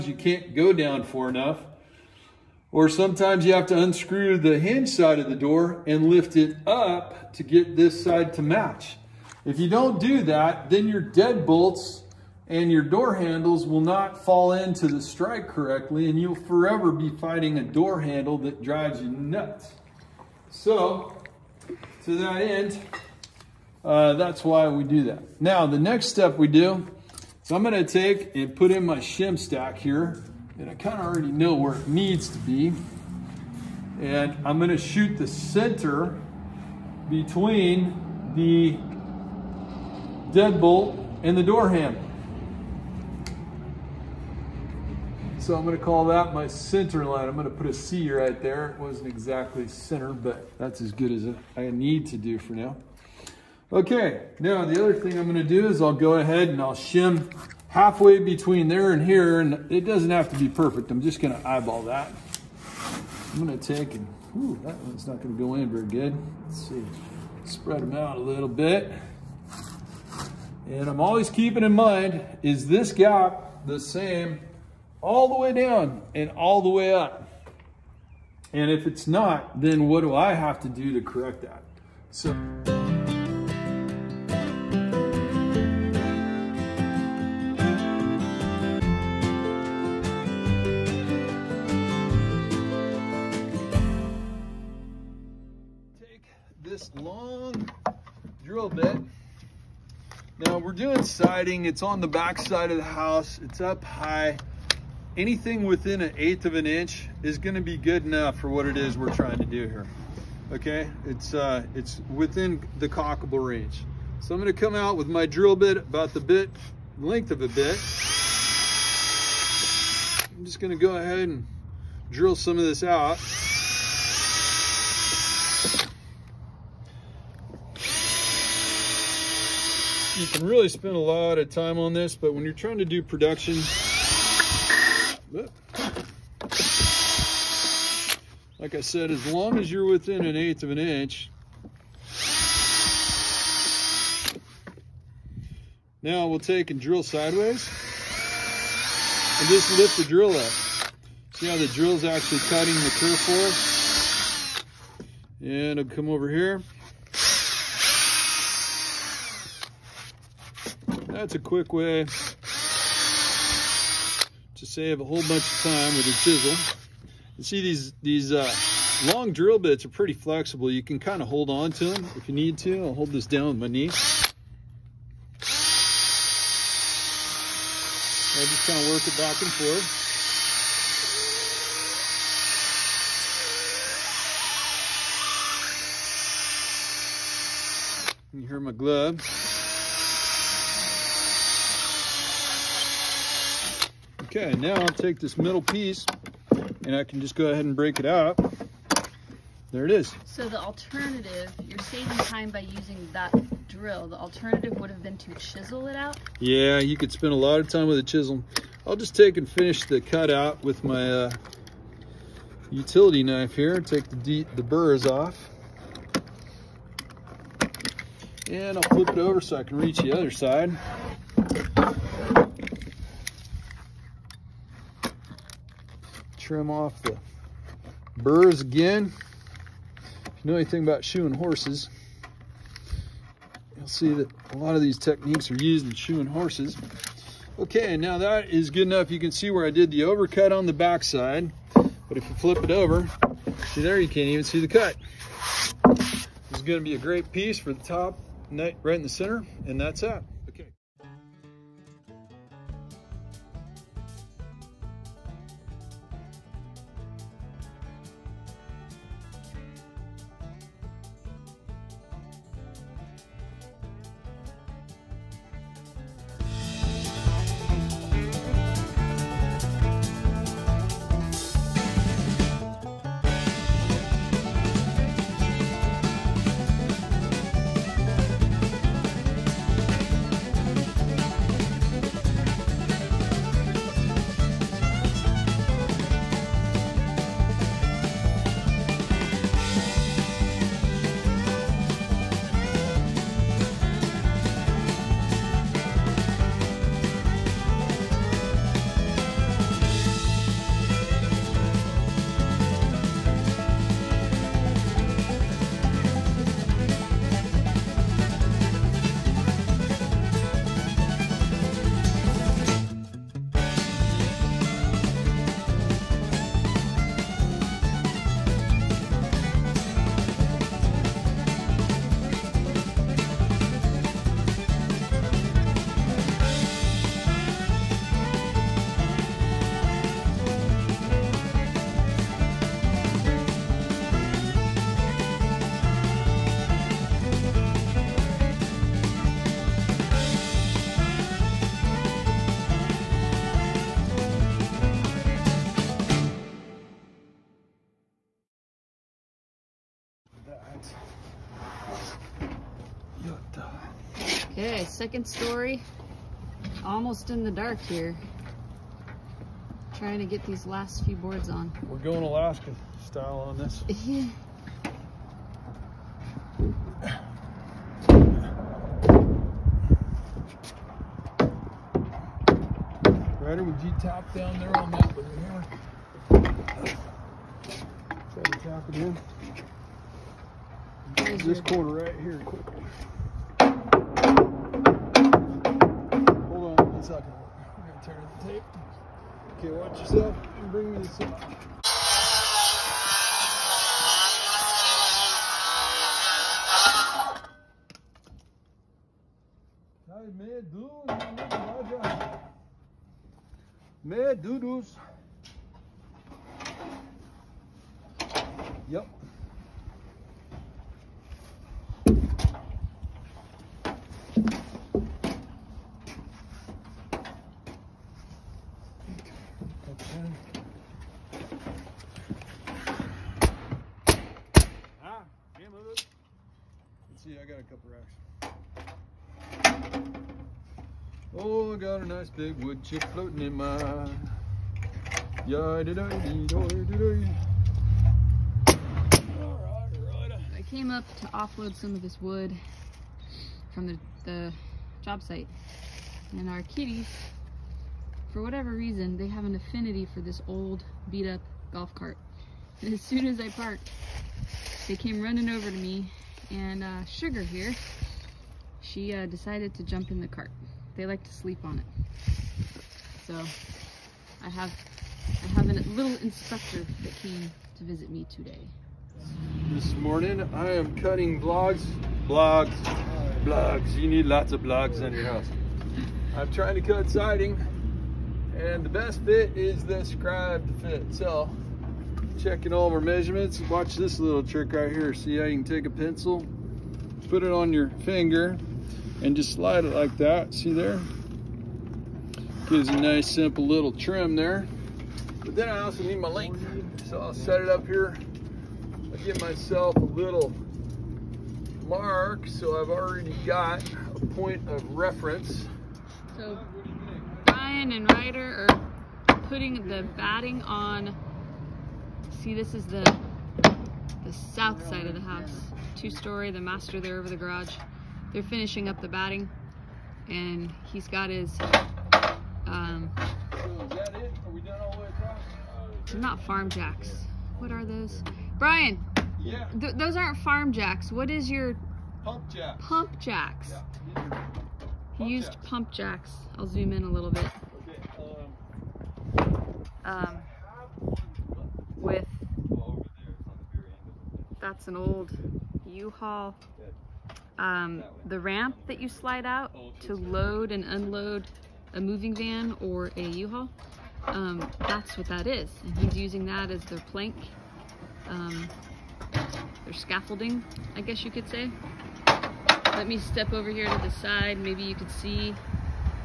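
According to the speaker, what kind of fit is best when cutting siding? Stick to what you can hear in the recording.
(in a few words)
scribe fit.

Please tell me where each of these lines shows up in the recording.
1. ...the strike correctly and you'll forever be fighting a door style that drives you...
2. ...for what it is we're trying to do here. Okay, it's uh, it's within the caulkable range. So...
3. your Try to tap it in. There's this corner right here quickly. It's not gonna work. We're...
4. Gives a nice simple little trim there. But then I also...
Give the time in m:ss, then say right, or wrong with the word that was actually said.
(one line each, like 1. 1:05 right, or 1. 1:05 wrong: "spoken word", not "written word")
1. 0:14 wrong: "handle", not "style"
2. 1:48 right
3. 6:16 right
4. 8:12 right.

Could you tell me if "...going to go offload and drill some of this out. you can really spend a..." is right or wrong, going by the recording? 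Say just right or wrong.
wrong.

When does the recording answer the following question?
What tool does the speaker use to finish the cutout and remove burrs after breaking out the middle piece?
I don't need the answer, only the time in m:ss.
3:32.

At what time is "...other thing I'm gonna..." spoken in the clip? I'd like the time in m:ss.
0:54.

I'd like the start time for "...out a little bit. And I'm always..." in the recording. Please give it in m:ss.
1:07.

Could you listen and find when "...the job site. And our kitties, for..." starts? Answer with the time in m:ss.
7:24.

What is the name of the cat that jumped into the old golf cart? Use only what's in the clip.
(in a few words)
Sugar.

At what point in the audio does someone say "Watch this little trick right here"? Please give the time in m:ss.
8:03.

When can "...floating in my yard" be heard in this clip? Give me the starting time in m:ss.
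7:13.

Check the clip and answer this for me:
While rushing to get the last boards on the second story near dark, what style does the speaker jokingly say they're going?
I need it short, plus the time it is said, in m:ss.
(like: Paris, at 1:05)
Alaska style, at 6:02.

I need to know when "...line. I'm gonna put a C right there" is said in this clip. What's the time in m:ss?
0:47.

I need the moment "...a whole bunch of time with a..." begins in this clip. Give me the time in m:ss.
2:44.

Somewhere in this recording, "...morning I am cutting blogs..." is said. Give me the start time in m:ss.
7:49.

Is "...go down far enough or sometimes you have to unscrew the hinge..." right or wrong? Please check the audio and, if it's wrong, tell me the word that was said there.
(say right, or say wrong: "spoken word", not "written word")
right.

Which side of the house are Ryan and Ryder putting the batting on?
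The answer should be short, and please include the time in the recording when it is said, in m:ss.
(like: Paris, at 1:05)
south side, at 8:34.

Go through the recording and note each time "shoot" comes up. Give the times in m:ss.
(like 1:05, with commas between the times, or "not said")
0:34.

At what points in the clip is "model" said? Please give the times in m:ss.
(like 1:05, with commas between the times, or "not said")
not said.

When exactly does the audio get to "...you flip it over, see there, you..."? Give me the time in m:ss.
4:02.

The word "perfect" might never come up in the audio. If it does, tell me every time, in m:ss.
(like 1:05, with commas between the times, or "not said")
1:00.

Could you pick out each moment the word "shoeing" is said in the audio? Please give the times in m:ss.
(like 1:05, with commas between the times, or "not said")
3:51, 3:55.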